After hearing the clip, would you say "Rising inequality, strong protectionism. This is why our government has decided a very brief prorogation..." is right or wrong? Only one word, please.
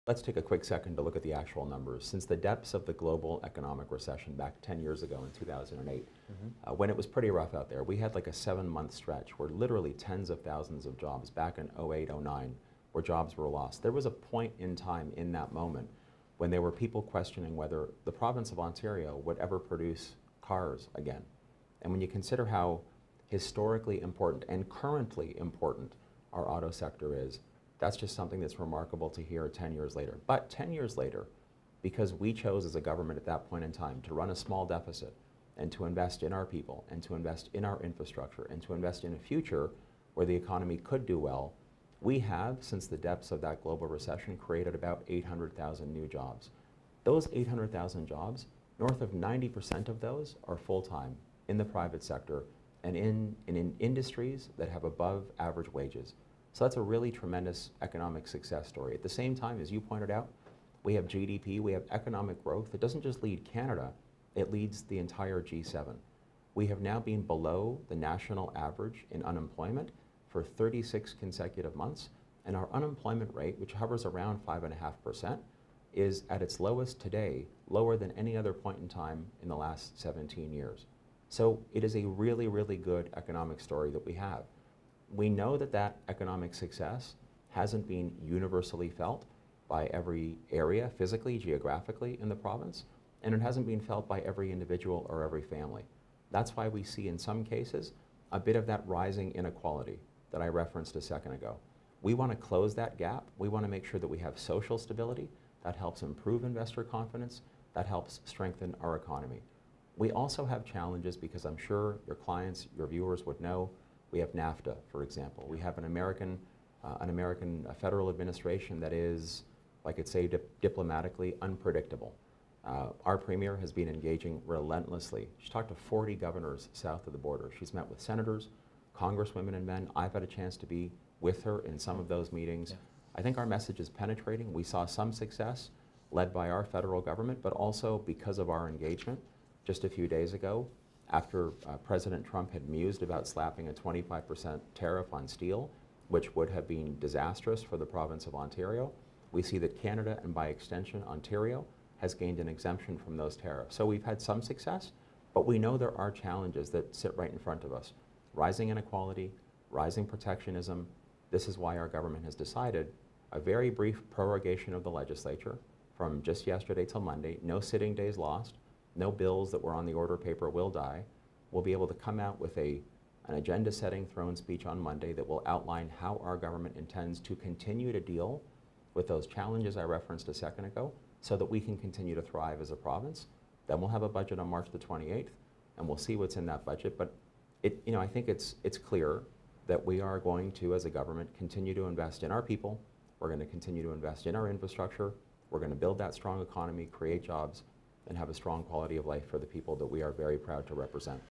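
wrong.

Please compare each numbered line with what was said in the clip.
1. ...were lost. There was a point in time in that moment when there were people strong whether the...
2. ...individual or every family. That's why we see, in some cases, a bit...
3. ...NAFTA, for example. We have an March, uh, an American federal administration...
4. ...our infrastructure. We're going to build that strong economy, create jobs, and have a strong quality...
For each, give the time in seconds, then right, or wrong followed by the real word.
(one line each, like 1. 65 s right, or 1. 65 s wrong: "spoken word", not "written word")
1. 13 s wrong: "questioning", not "strong"
2. 94 s right
3. 114 s wrong: "American", not "March"
4. 194 s right.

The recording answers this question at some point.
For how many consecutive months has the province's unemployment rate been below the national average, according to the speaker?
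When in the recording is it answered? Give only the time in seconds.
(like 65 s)
70 s.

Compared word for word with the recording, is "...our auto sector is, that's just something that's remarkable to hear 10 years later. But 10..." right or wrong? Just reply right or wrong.
right.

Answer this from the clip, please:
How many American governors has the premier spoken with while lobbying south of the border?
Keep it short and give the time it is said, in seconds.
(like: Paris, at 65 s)
40, at 125 s.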